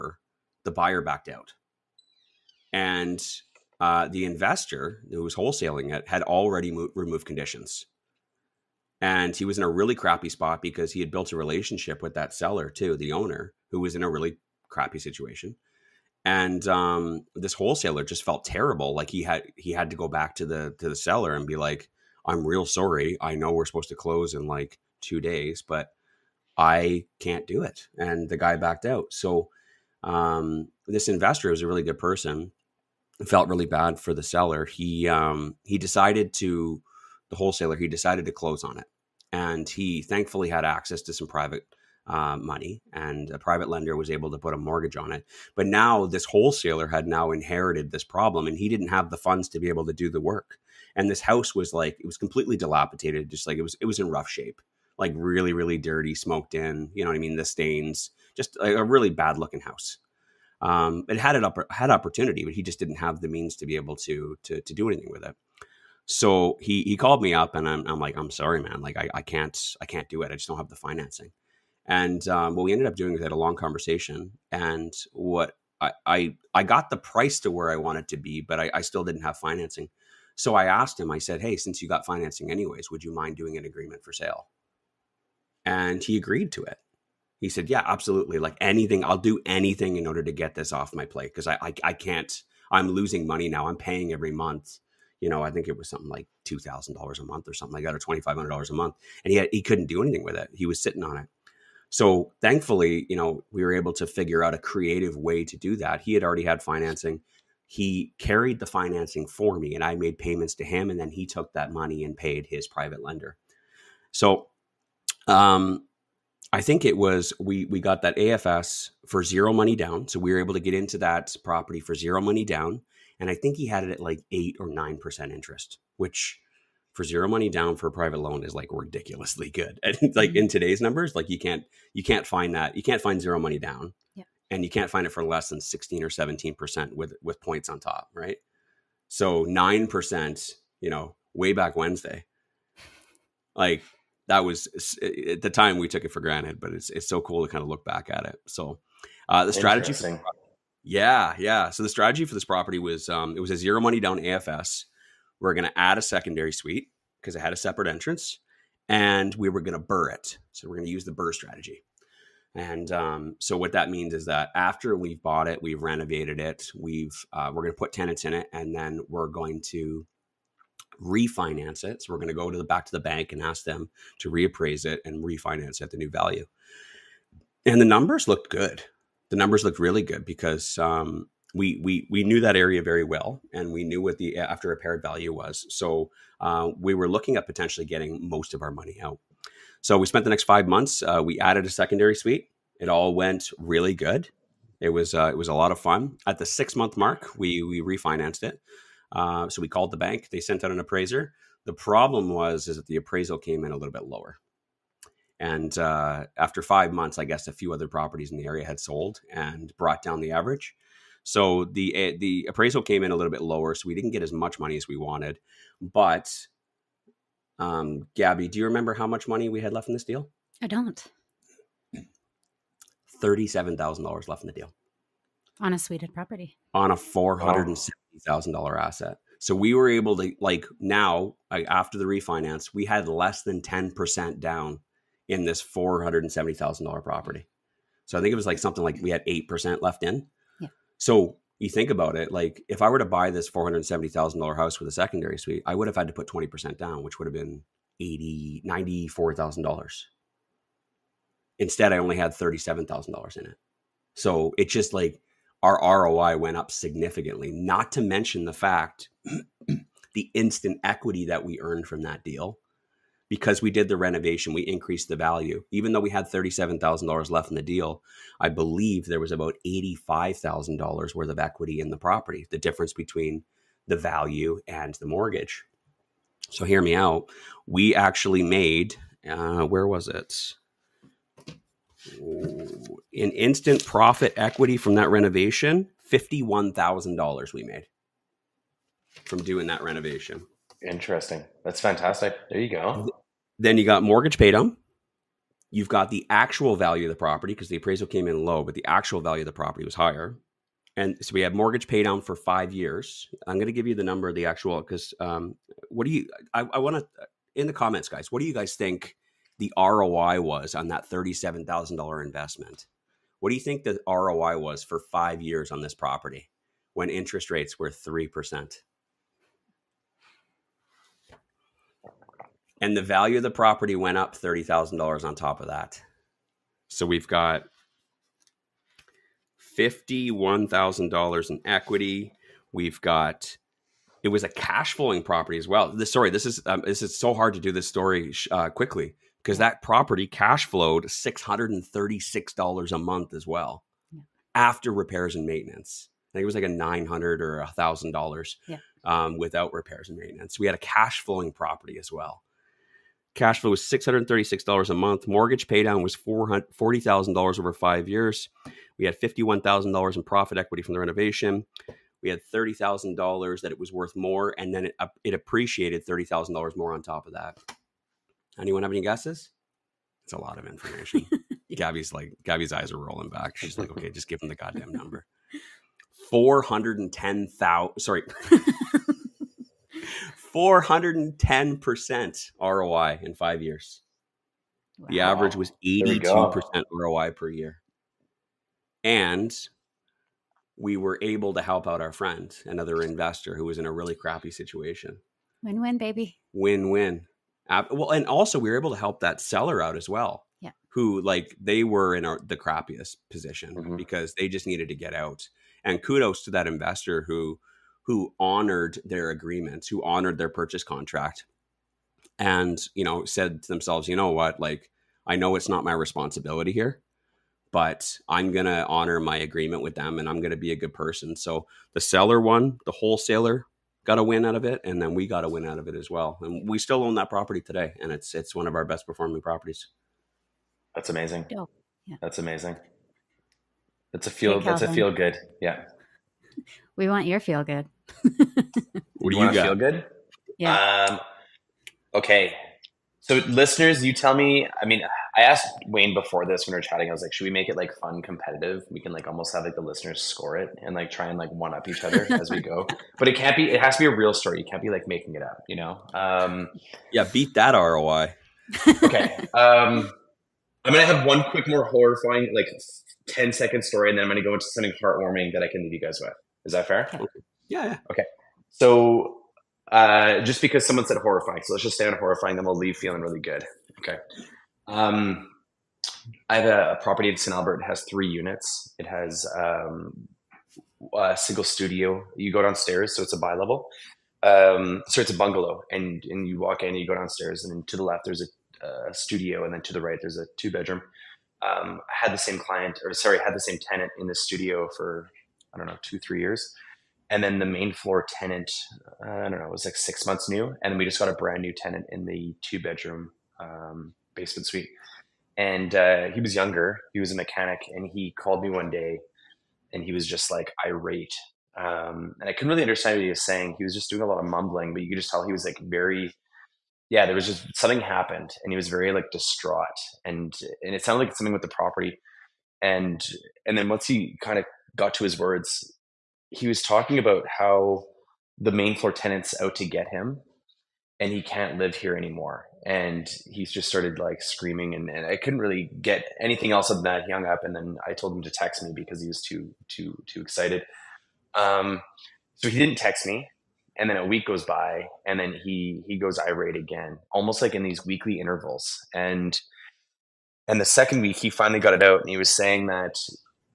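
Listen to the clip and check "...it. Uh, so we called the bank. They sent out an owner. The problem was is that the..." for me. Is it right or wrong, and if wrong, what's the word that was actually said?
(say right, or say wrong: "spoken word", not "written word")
wrong: "appraiser", not "owner".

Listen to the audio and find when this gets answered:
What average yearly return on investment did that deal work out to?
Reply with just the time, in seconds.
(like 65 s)
385 s.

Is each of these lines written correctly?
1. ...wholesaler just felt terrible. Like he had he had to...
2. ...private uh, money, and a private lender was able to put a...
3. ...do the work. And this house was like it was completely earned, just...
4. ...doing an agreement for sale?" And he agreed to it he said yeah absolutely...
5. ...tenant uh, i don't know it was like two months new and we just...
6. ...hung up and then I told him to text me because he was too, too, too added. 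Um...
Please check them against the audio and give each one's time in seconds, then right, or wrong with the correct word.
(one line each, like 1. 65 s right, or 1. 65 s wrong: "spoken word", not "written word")
1. 17 s right
2. 41 s right
3. 49 s wrong: "dilapidated", not "earned"
4. 83 s right
5. 498 s wrong: "six", not "two"
6. 537 s wrong: "excited", not "added".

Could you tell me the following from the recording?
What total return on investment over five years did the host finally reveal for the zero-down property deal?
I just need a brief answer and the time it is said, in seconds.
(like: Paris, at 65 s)
410%, at 380 s.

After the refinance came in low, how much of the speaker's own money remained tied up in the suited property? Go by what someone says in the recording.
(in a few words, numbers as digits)
$37,000.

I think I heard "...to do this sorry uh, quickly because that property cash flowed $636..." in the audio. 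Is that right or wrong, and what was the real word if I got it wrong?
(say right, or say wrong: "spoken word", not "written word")
wrong: "story", not "sorry".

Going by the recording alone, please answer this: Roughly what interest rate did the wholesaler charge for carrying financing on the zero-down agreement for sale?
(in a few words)
8 or 9 percent.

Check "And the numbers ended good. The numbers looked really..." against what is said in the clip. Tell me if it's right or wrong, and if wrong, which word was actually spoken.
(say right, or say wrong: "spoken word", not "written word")
wrong: "looked", not "ended".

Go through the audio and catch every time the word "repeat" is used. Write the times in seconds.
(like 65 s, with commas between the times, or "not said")
not said.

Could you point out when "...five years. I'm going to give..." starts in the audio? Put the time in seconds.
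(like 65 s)
302 s.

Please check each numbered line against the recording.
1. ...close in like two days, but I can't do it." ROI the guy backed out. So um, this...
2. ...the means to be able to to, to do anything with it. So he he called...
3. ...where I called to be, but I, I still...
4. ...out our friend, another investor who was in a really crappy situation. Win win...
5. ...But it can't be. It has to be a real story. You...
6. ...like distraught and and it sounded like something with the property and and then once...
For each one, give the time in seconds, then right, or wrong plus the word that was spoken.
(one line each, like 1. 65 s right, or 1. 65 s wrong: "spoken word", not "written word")
1. 23 s wrong: "And", not "ROI"
2. 63 s right
3. 77 s wrong: "wanted", not "called"
4. 391 s right
5. 453 s right
6. 519 s right.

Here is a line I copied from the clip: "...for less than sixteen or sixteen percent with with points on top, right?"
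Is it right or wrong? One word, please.
wrong.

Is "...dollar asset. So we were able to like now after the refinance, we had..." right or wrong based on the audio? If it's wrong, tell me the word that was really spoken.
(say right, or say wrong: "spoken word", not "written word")
right.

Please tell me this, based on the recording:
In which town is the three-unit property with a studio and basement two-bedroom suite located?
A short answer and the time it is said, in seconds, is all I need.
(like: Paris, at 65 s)
St. Albert, at 477 s.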